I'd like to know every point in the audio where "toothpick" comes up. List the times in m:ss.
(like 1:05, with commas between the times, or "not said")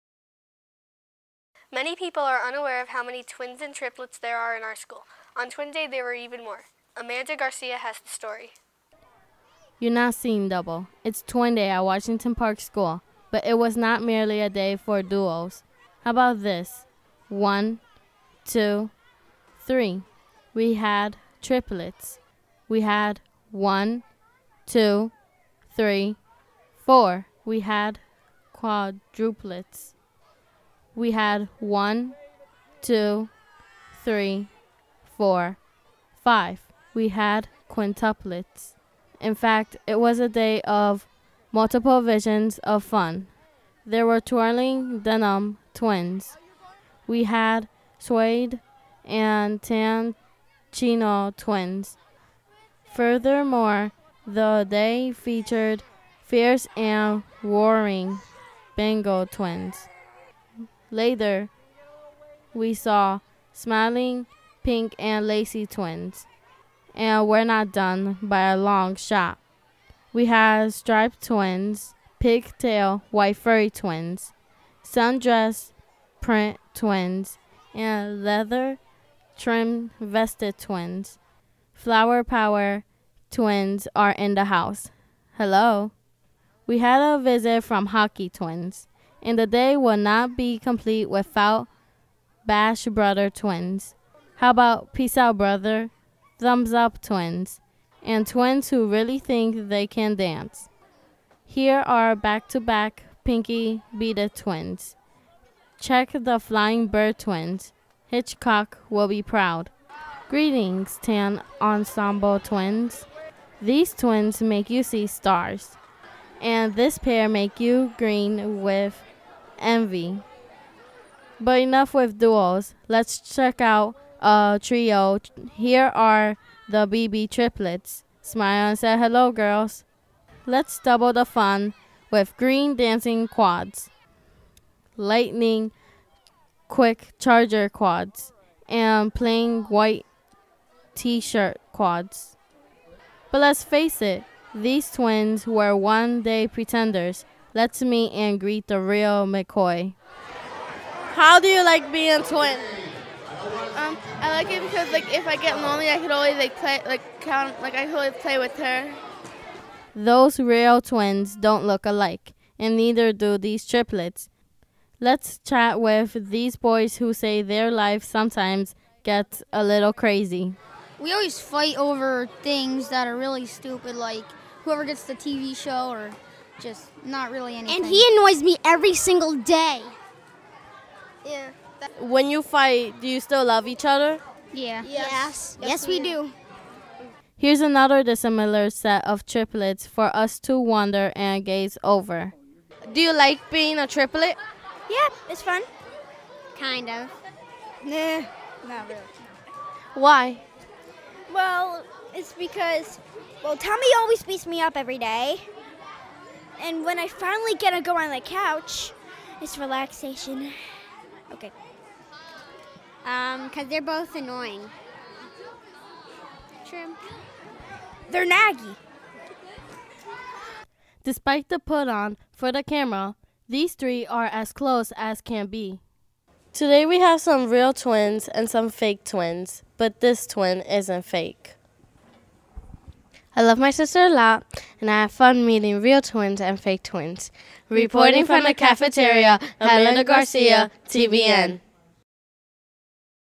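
not said.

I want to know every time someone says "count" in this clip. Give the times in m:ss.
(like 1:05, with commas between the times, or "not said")
2:37.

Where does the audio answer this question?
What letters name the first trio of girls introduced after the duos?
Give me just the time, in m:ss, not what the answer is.
2:06.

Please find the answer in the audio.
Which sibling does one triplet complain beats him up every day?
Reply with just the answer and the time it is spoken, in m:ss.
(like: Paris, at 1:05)
Tommy, at 3:23.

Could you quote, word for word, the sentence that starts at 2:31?
How do you like being twins?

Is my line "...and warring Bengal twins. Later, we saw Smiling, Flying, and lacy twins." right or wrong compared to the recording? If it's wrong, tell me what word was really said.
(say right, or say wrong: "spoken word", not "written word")
wrong: "Pink", not "Flying".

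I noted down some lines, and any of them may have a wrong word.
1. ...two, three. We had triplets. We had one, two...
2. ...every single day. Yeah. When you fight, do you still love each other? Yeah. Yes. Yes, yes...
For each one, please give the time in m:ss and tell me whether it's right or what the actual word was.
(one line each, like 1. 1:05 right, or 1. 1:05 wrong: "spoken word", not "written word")
1. 0:18 right
2. 2:58 right.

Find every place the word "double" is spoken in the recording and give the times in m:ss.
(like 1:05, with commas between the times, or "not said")
0:10, 2:10.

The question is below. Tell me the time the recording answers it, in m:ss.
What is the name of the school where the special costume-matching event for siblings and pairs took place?
0:11.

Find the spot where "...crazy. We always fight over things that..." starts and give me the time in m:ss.
2:49.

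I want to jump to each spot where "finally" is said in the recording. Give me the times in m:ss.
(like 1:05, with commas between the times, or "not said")
3:27.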